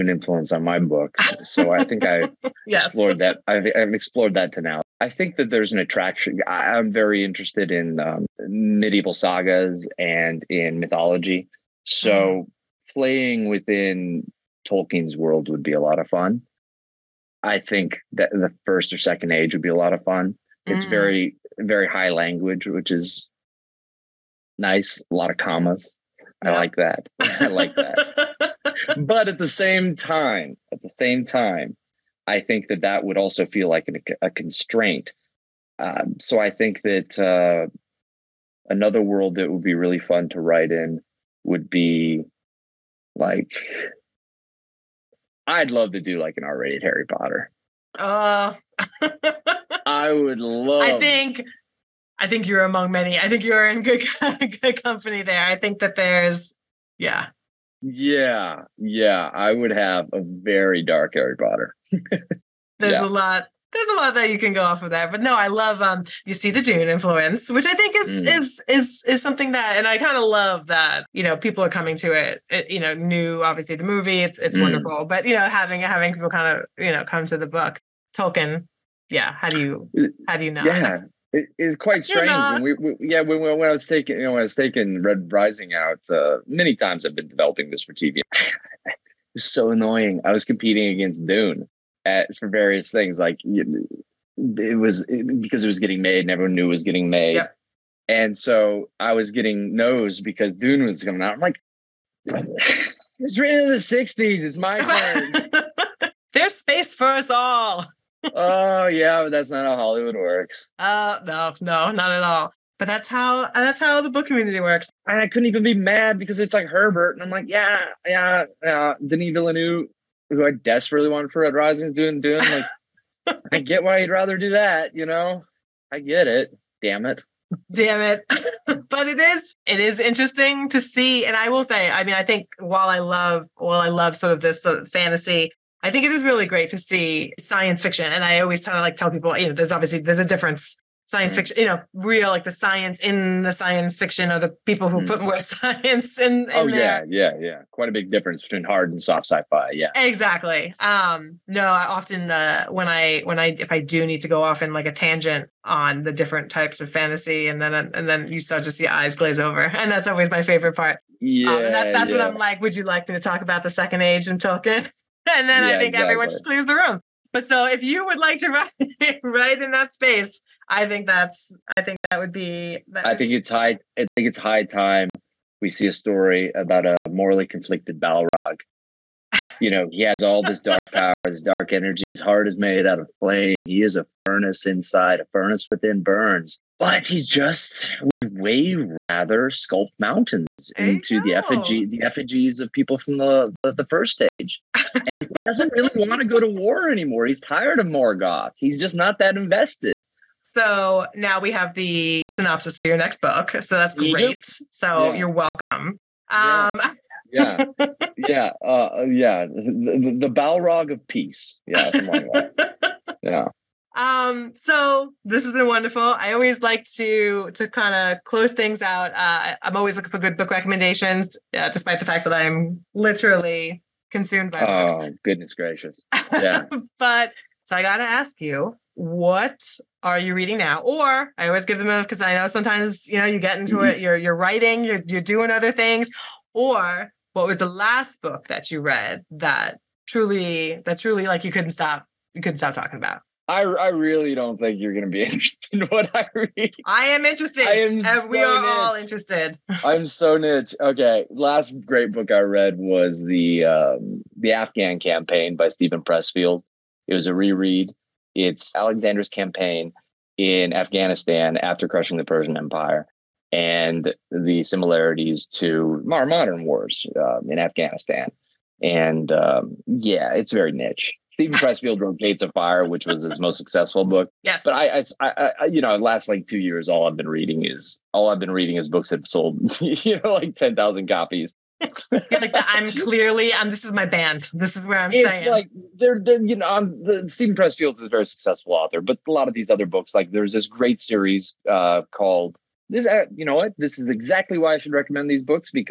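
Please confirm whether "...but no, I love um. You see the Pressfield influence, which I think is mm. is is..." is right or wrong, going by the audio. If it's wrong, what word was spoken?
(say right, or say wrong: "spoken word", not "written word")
wrong: "Dune", not "Pressfield".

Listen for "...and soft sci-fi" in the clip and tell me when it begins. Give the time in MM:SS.
02:28.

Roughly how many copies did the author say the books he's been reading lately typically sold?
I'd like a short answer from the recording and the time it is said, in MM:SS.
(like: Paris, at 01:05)
10,000, at 04:40.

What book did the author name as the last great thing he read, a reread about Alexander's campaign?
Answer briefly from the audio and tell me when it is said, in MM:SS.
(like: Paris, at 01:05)
The Afghan Campaign, at 04:14.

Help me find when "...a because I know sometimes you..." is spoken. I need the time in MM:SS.
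03:51.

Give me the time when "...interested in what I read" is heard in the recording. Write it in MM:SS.
04:05.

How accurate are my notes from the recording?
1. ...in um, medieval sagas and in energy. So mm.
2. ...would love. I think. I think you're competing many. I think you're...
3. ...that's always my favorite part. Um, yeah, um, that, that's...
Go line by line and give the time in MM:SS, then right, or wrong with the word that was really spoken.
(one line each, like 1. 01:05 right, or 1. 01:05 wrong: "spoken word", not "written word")
1. 00:07 wrong: "mythology", not "energy"
2. 00:50 wrong: "among", not "competing"
3. 02:39 right.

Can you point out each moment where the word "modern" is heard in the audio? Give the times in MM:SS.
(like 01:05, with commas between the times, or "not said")
04:26.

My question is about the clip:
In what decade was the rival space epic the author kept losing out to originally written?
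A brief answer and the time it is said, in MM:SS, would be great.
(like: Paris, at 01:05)
the '60s, at 01:43.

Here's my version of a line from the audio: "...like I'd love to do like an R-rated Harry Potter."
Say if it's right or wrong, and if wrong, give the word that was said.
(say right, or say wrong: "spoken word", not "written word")
right.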